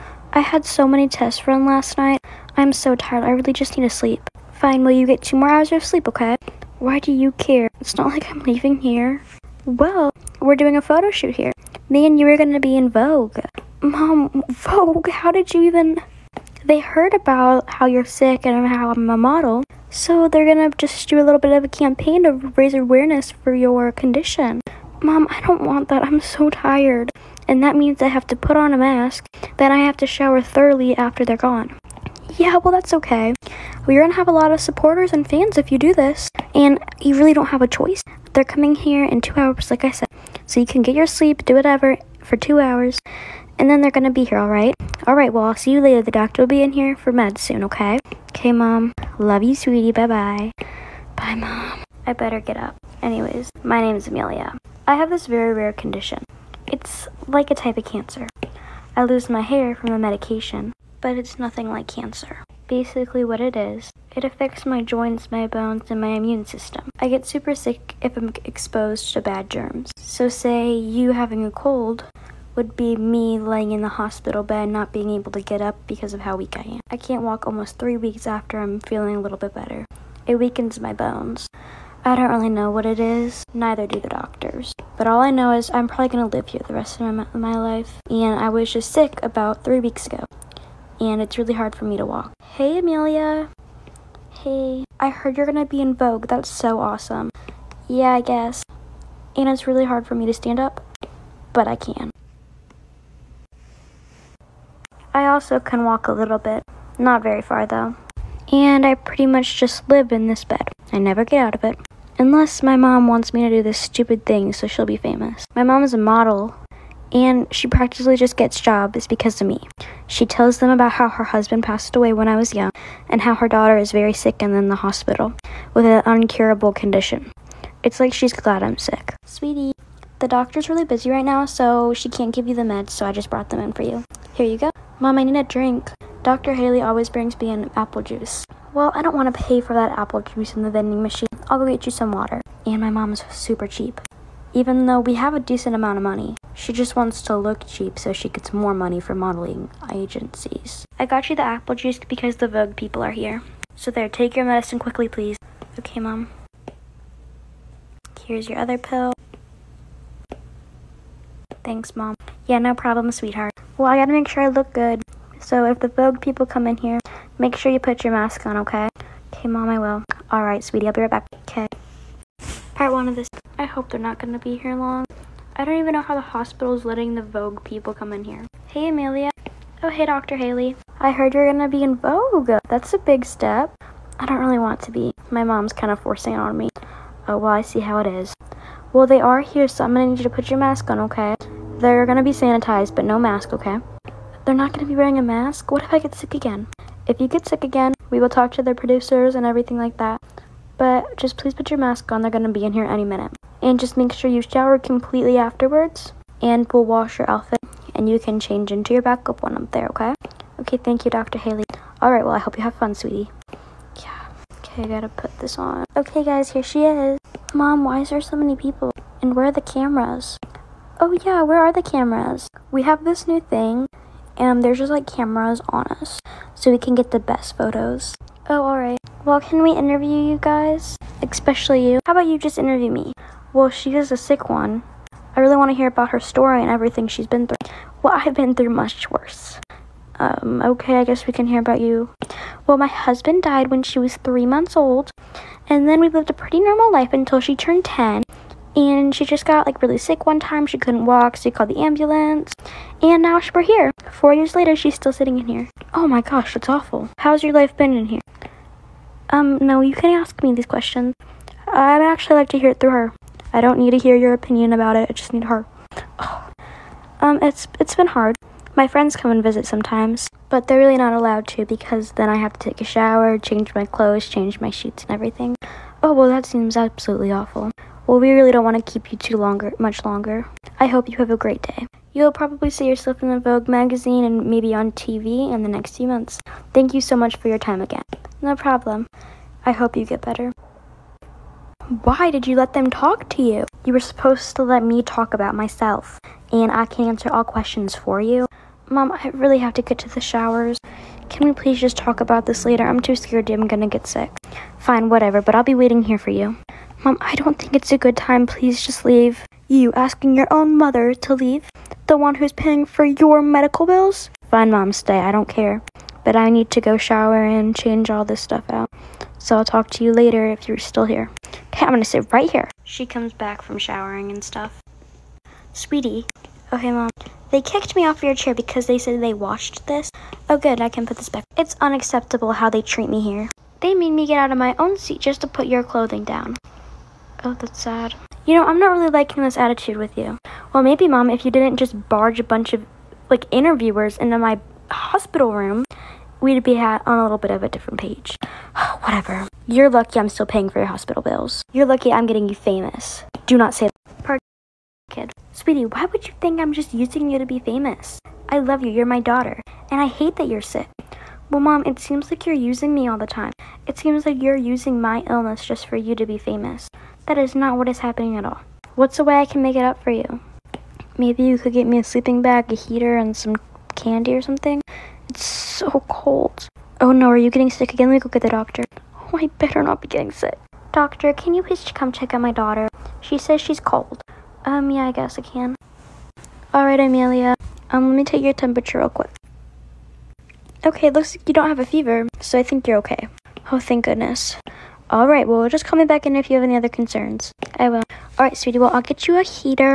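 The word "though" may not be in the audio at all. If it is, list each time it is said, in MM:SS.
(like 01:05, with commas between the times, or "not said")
01:47, 02:24.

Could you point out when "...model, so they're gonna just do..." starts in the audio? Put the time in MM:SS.
00:19.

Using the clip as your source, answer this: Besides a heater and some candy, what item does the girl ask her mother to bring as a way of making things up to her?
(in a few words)
sleeping bag.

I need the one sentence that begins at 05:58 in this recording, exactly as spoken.
I love you, you're my daughter, and I hate that you're sick.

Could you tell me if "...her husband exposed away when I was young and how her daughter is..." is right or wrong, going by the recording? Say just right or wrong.
wrong.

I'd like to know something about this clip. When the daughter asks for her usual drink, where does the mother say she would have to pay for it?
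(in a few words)
vending machine.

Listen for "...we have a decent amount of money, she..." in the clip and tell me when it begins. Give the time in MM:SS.
02:24.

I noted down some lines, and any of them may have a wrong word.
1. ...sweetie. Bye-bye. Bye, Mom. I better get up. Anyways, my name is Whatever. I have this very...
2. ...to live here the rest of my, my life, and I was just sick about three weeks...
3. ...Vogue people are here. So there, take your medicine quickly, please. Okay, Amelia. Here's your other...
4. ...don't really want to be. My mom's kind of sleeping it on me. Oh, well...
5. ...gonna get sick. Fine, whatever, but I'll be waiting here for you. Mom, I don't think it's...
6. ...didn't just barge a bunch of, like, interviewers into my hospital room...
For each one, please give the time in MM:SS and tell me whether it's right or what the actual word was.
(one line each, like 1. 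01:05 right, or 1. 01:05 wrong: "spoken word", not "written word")
1. 00:49 wrong: "Amelia", not "Whatever"
2. 01:26 right
3. 02:32 wrong: "Mom", not "Amelia"
4. 03:04 wrong: "forcing", not "sleeping"
5. 05:03 right
6. 05:41 right.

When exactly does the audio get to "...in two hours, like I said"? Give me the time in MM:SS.
00:39.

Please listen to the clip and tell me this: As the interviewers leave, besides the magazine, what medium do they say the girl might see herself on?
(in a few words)
TV.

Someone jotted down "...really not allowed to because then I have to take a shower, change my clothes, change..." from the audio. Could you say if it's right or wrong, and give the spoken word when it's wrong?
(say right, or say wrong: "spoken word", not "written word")
right.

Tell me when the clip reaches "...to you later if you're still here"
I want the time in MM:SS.
05:19.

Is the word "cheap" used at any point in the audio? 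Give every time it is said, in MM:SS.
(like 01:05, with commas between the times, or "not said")
02:23, 02:27.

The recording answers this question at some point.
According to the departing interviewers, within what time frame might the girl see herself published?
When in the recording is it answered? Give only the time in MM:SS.
04:45.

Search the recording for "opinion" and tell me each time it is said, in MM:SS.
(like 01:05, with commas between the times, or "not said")
04:24.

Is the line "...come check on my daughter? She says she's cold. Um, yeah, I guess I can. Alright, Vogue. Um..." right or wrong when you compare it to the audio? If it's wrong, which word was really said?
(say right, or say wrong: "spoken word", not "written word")
wrong: "Amelia", not "Vogue".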